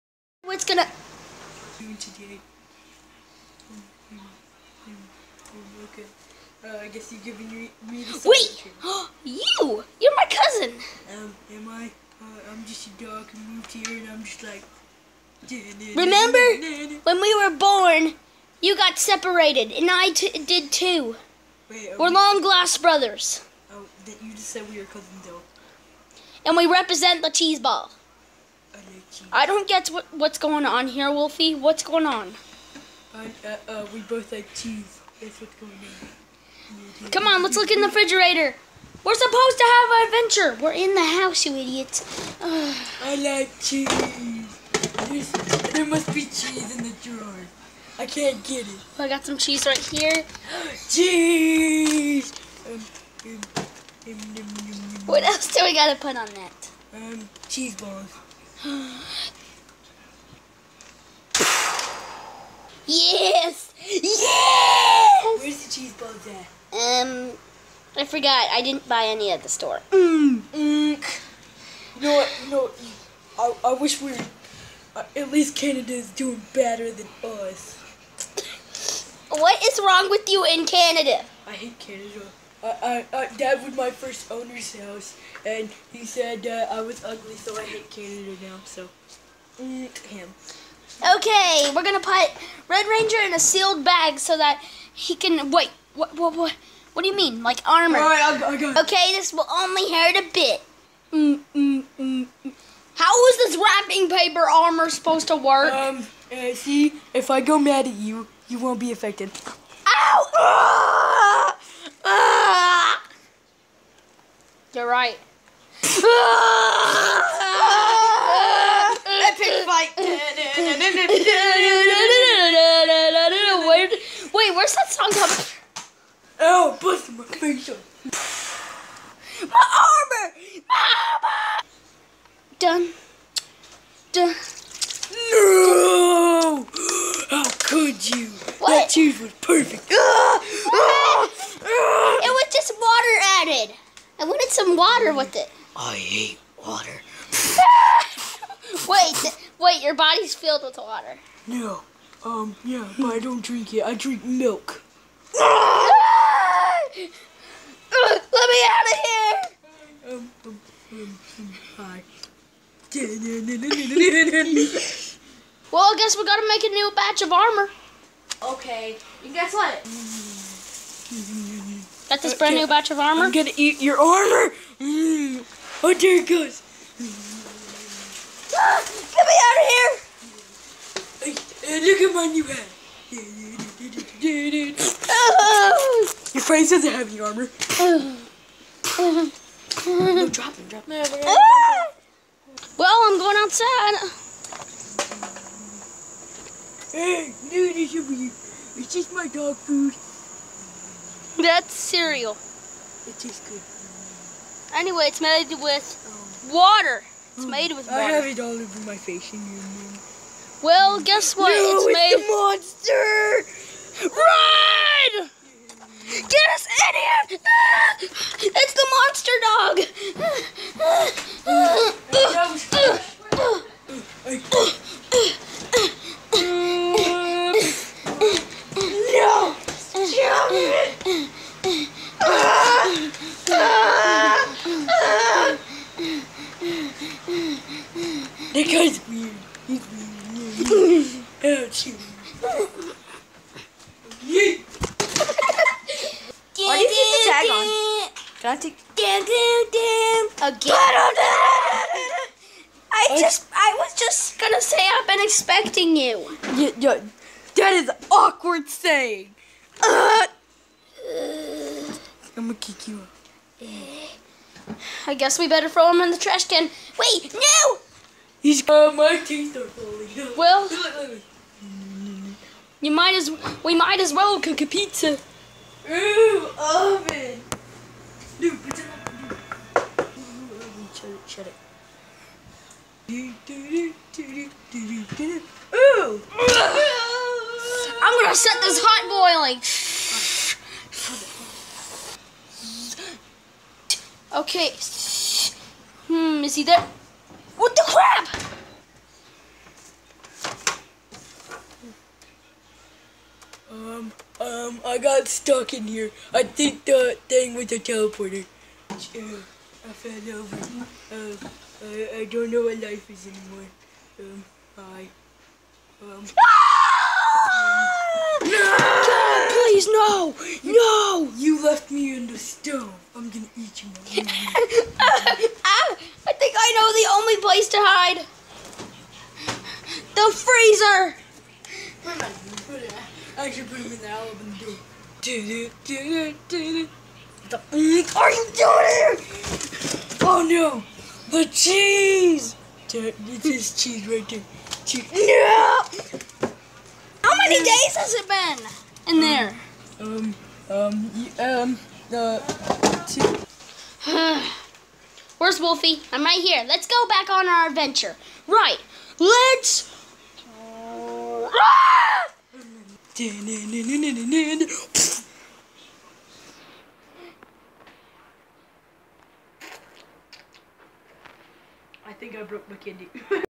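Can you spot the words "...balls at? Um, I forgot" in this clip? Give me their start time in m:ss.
1:05.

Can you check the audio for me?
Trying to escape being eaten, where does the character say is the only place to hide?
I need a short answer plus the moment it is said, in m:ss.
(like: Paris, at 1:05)
The freezer, at 5:30.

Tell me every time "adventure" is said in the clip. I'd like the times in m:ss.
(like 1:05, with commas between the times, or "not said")
0:40, 5:57.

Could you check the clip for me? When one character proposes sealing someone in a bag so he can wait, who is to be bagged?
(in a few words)
Red Ranger.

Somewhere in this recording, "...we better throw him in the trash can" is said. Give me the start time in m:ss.
4:25.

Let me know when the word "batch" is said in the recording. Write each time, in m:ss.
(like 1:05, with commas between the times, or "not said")
2:46, 2:52.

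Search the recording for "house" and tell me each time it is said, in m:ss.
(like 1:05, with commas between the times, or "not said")
0:41, 1:24.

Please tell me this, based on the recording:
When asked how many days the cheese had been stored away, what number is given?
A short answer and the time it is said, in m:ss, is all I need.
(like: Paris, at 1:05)
2, at 5:53.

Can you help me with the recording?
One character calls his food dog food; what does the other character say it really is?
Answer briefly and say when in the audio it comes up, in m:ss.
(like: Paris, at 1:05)
Cereal, at 3:21.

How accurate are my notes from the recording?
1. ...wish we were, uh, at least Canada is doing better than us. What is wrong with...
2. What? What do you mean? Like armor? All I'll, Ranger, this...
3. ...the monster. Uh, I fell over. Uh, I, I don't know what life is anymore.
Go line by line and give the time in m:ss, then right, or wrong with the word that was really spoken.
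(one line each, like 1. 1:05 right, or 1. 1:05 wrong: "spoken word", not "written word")
1. 1:13 right
2. 1:36 wrong: "Okay", not "Ranger"
3. 5:07 wrong: "teleporter", not "monster".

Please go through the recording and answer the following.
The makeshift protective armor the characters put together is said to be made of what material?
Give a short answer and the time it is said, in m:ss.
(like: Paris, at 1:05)
Wrapping paper, at 1:43.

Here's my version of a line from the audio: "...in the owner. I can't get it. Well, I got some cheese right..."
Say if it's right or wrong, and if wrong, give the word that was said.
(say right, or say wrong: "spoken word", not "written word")
wrong: "drawer", not "owner".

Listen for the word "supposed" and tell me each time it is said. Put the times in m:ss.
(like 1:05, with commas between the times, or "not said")
0:39, 1:44.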